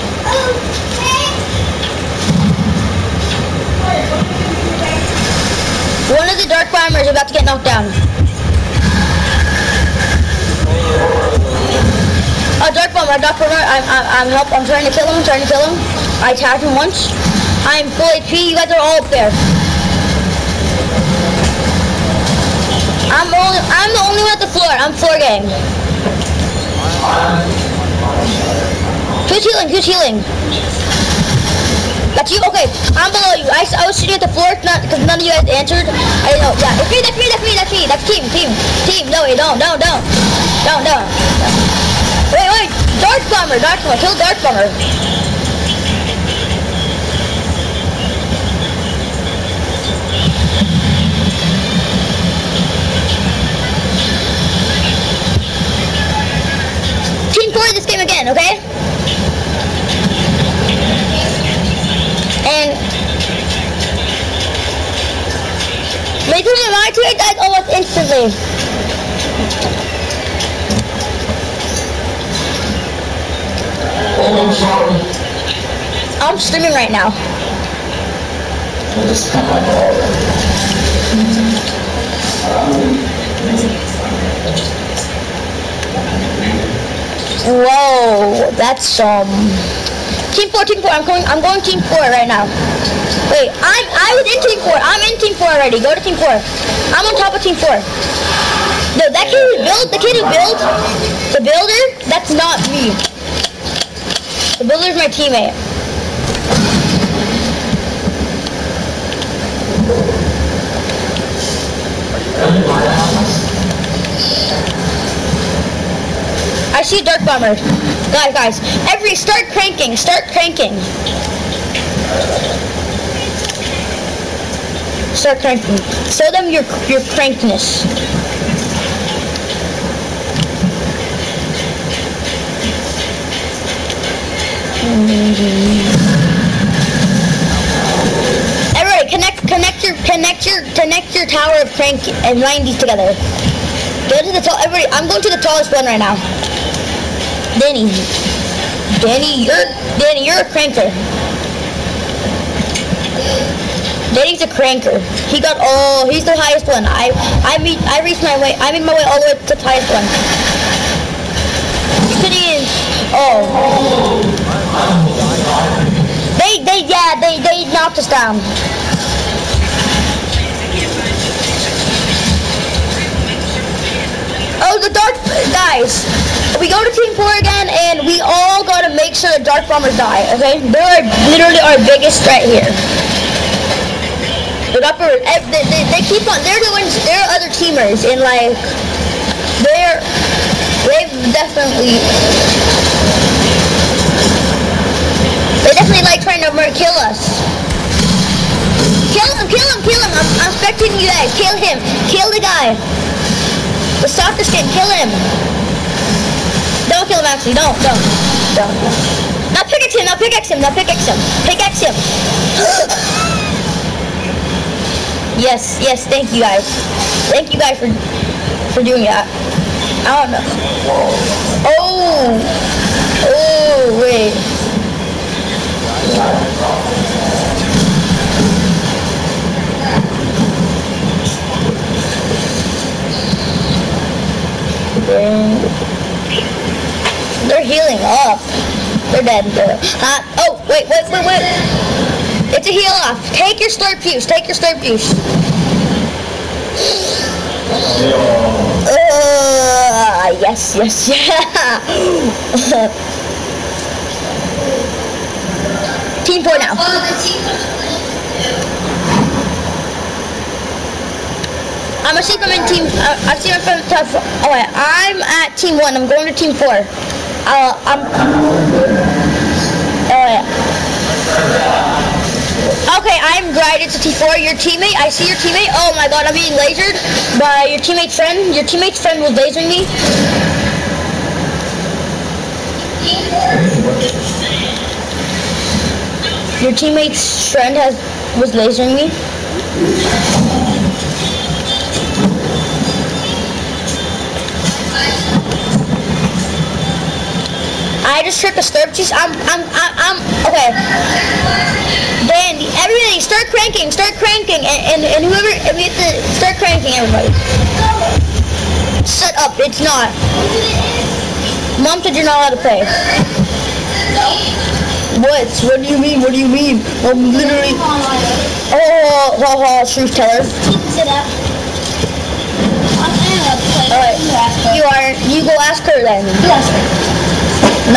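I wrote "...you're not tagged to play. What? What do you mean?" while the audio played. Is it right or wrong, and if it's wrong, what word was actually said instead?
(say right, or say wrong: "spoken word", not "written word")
wrong: "allowed", not "tagged".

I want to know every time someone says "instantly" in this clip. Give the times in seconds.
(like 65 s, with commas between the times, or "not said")
67 s.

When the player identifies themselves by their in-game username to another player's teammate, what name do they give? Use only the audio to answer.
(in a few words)
Bride64.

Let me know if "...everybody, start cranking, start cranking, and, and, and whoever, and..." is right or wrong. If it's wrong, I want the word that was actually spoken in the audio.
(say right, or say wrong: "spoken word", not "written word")
right.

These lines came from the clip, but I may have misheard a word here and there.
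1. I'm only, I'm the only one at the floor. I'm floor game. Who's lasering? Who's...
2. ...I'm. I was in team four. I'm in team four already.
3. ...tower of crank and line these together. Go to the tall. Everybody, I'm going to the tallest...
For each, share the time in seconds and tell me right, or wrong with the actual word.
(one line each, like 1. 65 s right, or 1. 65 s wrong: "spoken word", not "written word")
1. 23 s wrong: "healing", not "lasering"
2. 93 s right
3. 141 s right.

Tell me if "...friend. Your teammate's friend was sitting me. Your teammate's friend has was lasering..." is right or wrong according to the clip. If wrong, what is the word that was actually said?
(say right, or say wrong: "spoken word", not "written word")
wrong: "lasering", not "sitting".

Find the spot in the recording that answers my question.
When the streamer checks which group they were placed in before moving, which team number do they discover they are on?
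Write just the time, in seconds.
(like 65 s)
265 s.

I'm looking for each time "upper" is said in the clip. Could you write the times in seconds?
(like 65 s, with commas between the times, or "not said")
184 s.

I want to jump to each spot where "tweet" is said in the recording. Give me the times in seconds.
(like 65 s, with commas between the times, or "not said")
66 s.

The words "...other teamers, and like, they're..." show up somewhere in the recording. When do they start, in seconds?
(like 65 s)
187 s.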